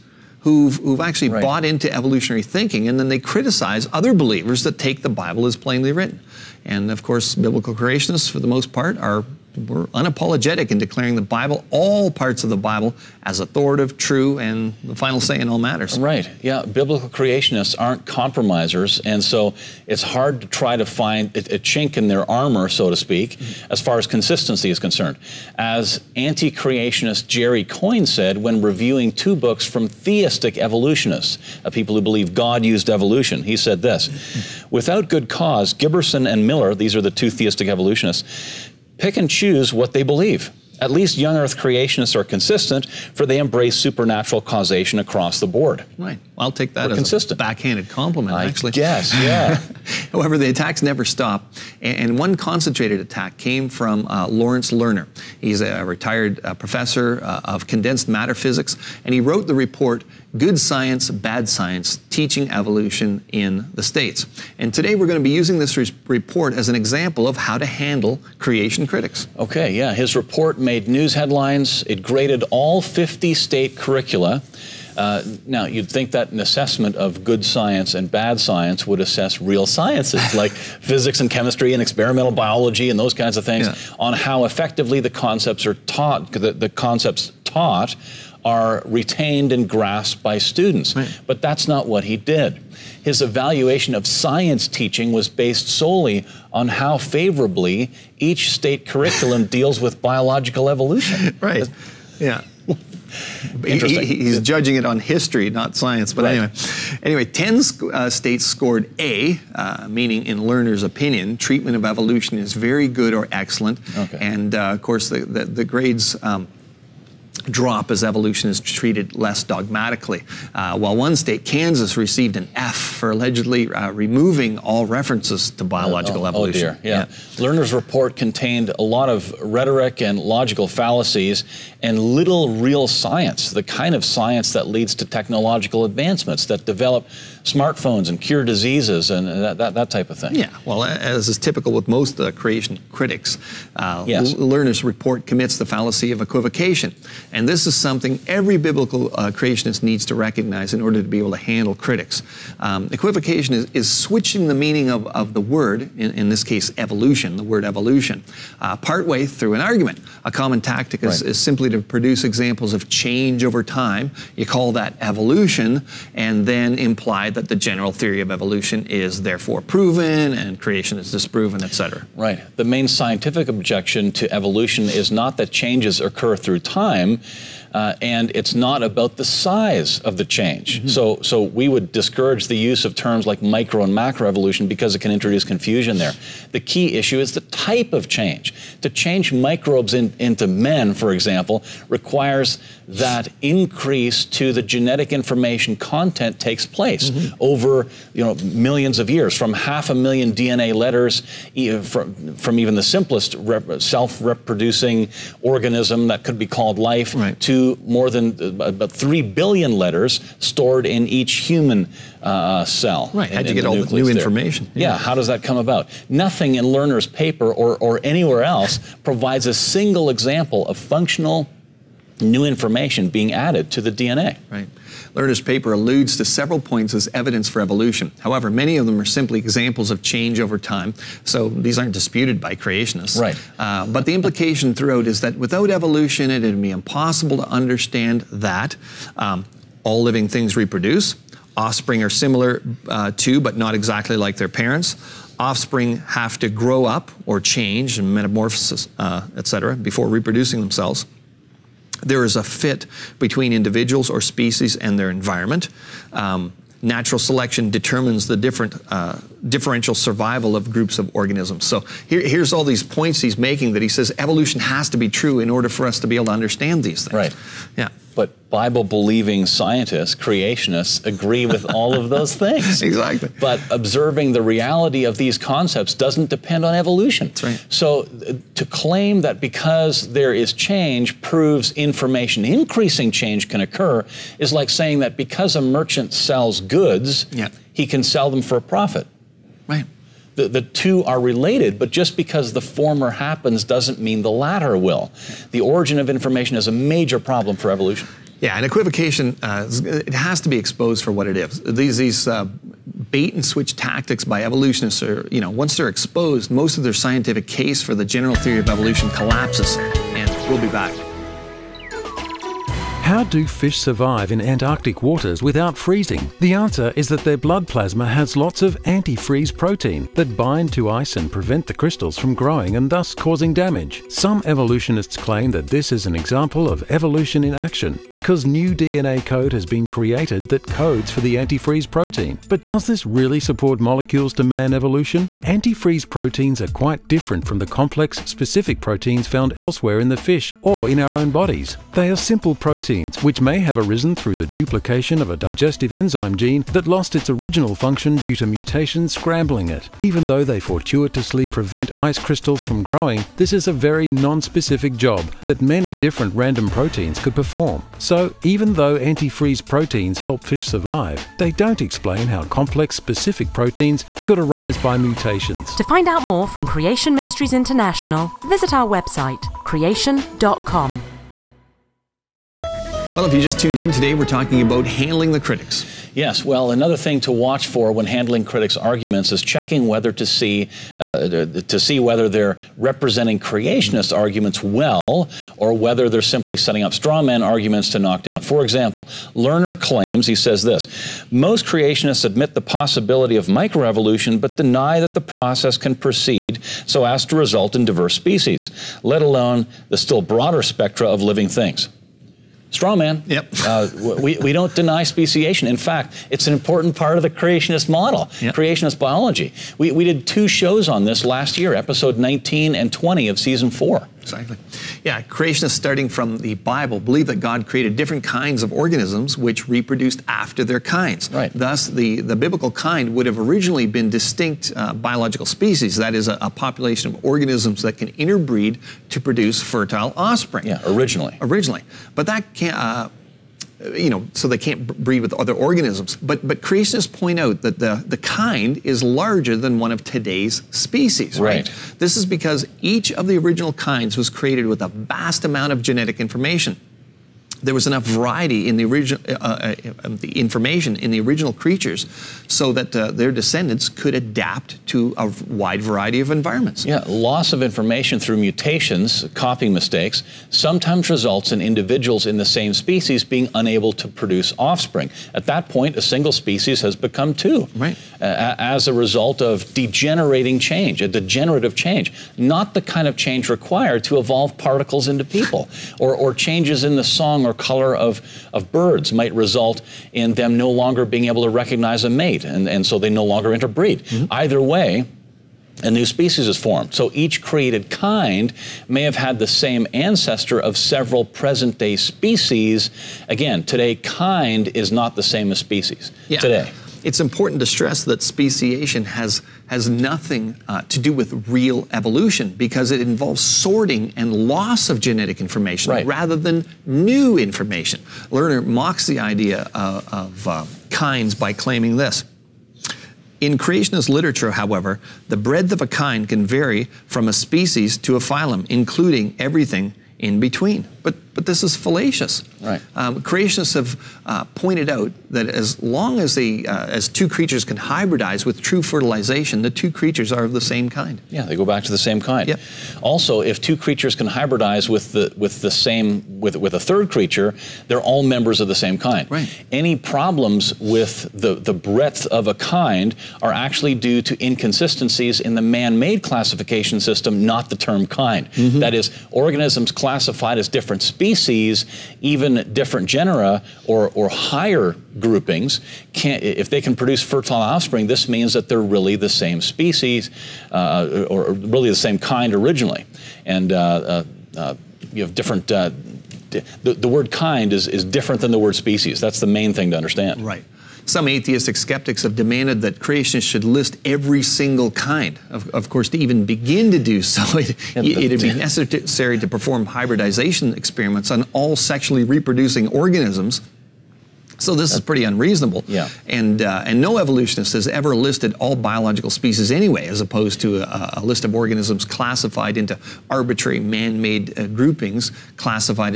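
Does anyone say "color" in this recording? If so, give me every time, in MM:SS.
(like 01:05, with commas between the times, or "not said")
07:57.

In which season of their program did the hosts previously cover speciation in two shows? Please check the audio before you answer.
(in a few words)
season four.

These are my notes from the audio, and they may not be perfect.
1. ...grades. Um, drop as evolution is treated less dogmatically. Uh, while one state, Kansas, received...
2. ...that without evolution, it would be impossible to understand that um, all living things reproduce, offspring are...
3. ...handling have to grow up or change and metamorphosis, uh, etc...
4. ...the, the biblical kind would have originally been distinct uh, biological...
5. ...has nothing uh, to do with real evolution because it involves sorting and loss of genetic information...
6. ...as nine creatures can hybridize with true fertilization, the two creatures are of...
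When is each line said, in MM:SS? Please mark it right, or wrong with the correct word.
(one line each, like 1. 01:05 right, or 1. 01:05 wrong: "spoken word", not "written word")
1. 01:55 right
2. 03:55 right
3. 04:05 wrong: "offspring", not "handling"
4. 07:01 right
5. 08:19 right
6. 08:46 wrong: "two", not "nine".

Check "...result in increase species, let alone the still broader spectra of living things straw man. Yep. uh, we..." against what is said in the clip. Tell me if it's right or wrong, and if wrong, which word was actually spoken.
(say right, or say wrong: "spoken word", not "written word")
wrong: "diverse", not "increase".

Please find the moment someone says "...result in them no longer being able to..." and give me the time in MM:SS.
07:59.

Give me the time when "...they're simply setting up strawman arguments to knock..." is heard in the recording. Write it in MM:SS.
06:26.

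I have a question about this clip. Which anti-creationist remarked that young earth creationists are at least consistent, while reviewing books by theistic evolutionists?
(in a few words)
Jerry Coyne.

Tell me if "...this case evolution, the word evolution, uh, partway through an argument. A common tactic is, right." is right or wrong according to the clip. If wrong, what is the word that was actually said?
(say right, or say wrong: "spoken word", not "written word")
right.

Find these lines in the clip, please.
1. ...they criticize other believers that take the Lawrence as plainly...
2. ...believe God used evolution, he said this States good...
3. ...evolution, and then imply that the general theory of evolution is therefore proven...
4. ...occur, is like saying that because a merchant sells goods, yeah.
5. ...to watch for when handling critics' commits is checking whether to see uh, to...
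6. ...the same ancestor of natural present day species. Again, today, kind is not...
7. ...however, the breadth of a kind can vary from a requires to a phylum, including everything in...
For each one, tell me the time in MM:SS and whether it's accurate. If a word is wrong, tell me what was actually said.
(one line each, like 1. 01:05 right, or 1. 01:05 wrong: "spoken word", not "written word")
1. 00:03 wrong: "Bible", not "Lawrence"
2. 00:32 wrong: "Without", not "States"
3. 02:44 right
4. 04:43 right
5. 06:17 wrong: "arguments", not "commits"
6. 08:09 wrong: "several", not "natural"
7. 08:34 wrong: "species", not "requires".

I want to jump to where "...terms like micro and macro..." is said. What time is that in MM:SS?
03:02.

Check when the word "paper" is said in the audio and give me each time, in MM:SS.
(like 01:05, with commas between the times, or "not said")
03:37, 03:45.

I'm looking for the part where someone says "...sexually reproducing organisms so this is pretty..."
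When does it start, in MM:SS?
09:41.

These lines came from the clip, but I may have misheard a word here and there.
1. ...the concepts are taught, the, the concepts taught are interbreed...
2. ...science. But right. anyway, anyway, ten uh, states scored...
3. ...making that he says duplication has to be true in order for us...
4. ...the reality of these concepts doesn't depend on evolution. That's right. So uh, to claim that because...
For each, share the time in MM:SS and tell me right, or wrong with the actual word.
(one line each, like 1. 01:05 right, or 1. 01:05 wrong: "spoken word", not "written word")
1. 01:24 wrong: "retained", not "interbreed"
2. 01:45 right
3. 04:23 wrong: "evolution", not "duplication"
4. 04:34 right.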